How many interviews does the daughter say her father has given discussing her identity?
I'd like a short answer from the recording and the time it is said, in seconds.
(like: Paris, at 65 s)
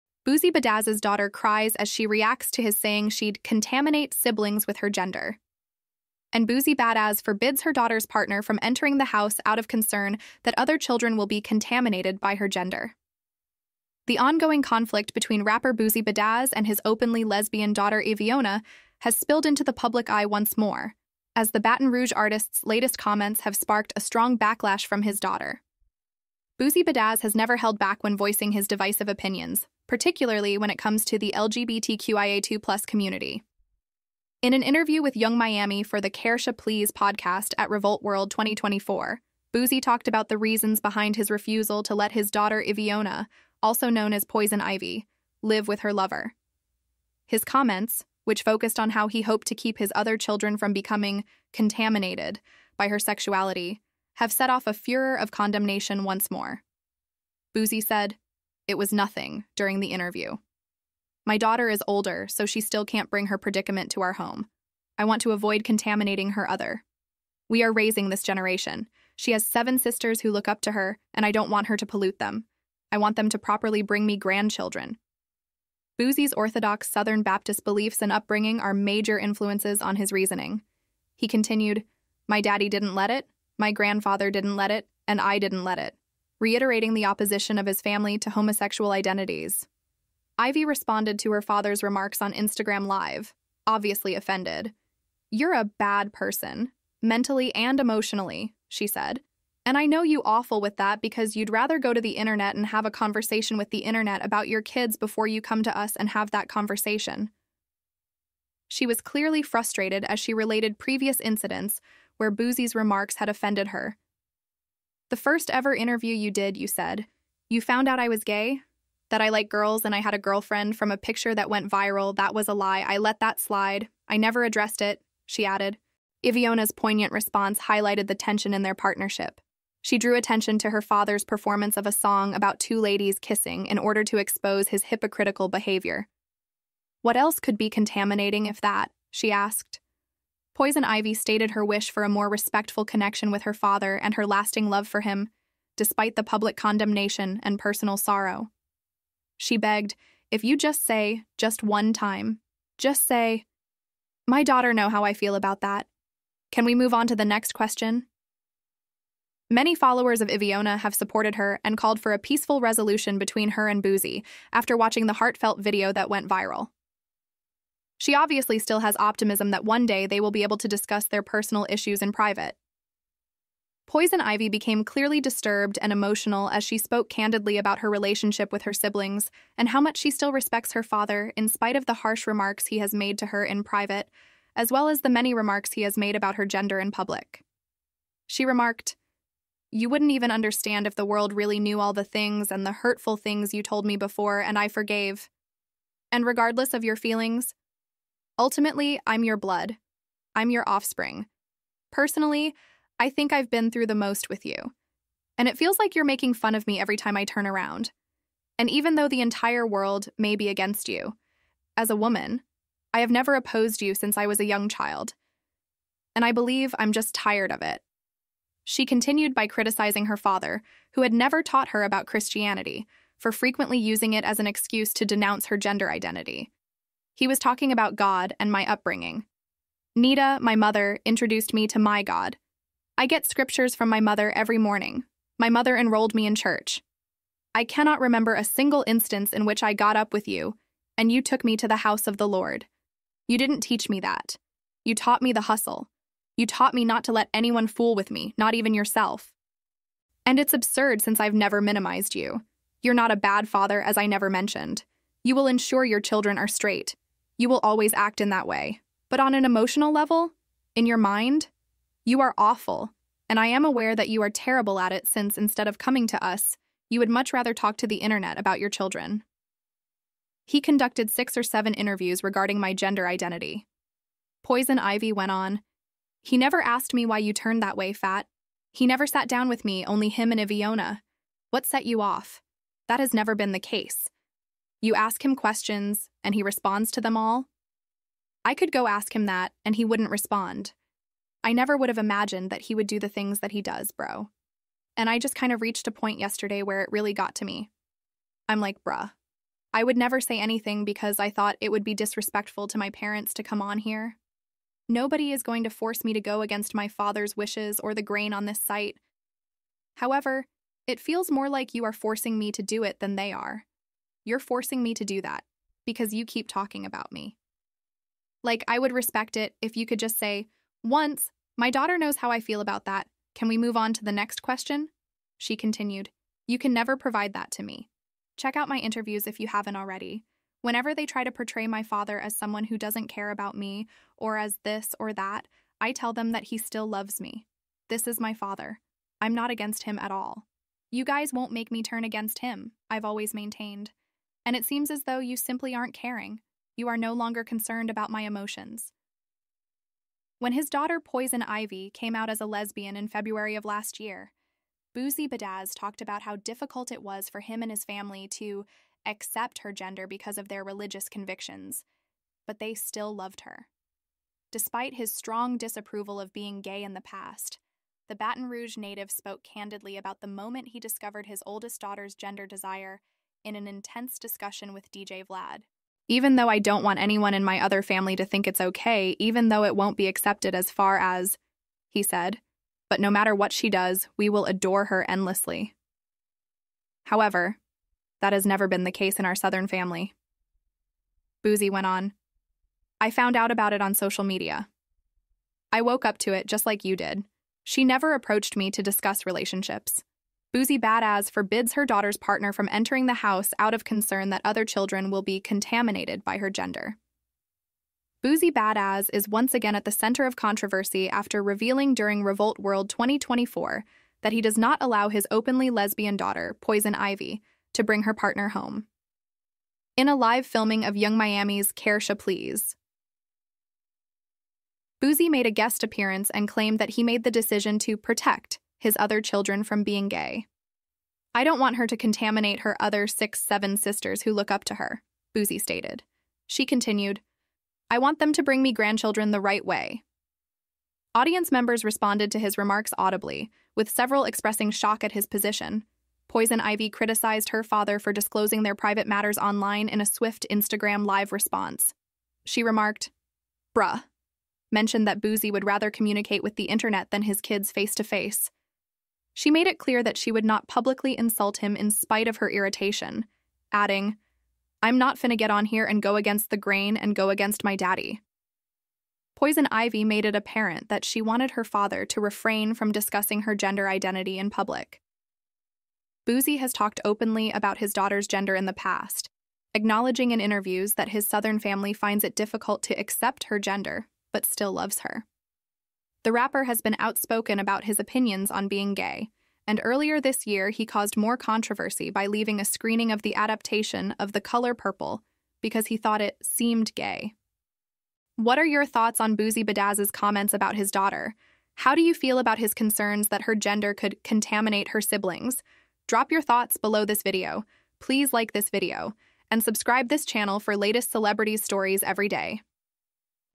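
6 or 7, at 271 s.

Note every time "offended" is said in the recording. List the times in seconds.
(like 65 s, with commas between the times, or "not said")
94 s, 113 s.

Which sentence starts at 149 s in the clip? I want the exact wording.
She begged, if you just say, just one time, just say, my daughter know how I feel about that.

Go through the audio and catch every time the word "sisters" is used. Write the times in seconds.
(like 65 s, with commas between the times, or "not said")
69 s, 433 s.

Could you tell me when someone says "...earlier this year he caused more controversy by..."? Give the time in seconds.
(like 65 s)
489 s.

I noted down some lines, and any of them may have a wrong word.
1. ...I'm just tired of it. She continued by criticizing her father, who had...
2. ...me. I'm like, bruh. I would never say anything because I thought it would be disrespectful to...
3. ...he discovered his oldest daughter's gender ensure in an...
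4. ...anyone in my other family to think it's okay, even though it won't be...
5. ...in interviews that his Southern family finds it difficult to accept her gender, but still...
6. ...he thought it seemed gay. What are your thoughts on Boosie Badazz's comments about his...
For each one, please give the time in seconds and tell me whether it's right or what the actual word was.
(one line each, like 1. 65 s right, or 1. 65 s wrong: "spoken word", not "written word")
1. 216 s right
2. 297 s right
3. 370 s wrong: "desire", not "ensure"
4. 376 s right
5. 480 s right
6. 495 s right.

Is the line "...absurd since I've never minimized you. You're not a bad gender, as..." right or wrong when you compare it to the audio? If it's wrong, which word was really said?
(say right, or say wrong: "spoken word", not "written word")
wrong: "father", not "gender".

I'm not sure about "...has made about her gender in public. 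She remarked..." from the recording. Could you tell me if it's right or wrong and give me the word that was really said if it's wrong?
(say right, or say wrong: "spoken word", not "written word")
right.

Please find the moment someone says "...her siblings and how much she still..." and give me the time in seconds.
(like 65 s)
178 s.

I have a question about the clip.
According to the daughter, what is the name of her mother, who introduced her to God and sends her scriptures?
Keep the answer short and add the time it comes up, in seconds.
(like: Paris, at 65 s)
Nita, at 229 s.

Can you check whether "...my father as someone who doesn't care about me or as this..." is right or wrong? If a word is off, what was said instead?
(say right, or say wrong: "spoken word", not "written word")
right.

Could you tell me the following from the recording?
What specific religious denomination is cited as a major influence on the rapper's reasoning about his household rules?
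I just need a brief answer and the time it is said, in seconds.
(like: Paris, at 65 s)
Southern Baptist, at 76 s.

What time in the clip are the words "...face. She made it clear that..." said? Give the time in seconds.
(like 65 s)
458 s.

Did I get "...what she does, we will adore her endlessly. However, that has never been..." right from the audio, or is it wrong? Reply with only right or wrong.
right.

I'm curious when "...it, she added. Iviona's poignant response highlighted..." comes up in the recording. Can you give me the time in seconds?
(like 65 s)
124 s.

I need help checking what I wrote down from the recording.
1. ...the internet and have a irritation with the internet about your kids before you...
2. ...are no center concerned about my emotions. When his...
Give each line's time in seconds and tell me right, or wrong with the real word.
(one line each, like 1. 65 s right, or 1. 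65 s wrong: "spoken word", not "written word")
1. 102 s wrong: "conversation", not "irritation"
2. 346 s wrong: "longer", not "center".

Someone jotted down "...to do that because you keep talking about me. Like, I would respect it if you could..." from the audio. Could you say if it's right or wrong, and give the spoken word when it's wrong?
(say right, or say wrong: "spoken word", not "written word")
right.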